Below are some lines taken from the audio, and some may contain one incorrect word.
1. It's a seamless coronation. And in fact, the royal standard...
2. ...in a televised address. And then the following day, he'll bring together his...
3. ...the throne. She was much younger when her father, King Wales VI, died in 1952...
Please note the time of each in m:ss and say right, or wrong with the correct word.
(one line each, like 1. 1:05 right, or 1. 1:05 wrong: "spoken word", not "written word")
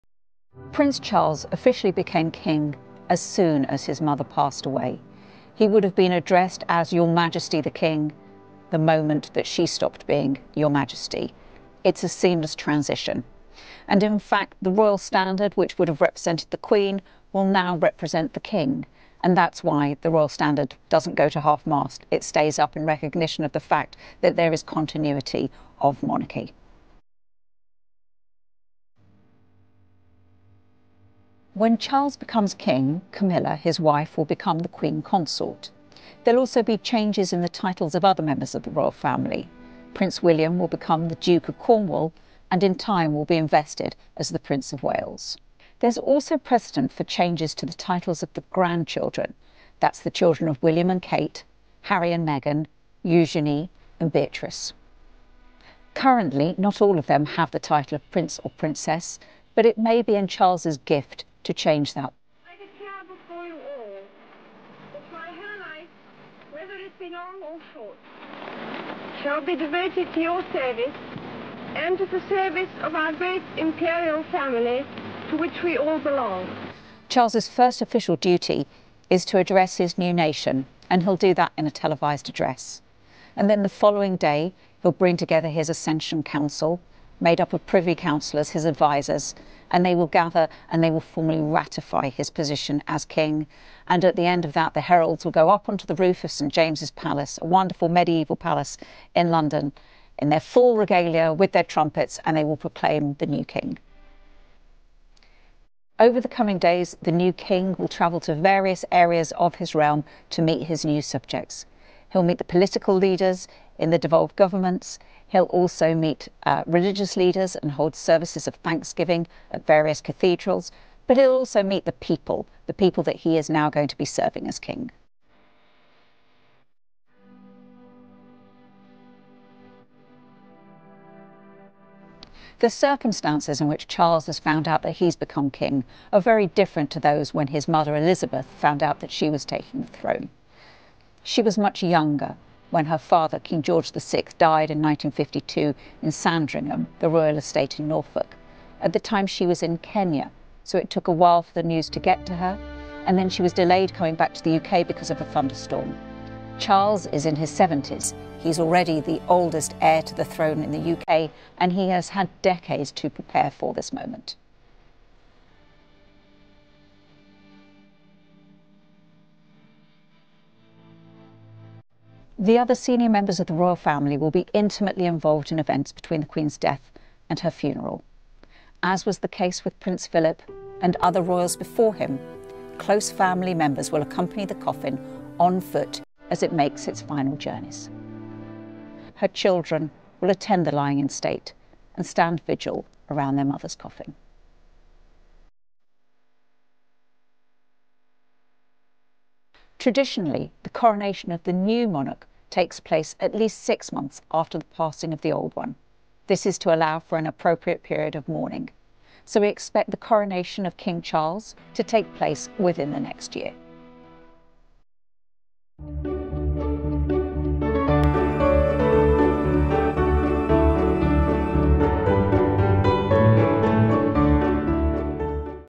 1. 0:11 wrong: "transition", not "coronation"
2. 1:21 right
3. 2:19 wrong: "George", not "Wales".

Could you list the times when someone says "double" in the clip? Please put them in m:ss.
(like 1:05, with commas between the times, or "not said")
not said.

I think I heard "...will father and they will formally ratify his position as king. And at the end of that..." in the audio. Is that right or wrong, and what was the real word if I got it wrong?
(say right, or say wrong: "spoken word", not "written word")
wrong: "gather", not "father".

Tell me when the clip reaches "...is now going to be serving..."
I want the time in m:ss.
2:03.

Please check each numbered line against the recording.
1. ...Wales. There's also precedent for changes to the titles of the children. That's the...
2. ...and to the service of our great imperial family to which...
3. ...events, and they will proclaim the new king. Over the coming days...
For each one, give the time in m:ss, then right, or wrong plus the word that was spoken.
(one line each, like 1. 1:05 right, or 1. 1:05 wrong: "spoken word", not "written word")
1. 0:44 wrong: "grandchildren", not "children"
2. 1:11 right
3. 1:41 wrong: "trumpets", not "events".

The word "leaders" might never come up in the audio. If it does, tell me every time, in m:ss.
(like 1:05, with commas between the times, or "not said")
1:52, 1:57.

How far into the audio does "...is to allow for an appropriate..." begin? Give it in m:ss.
3:26.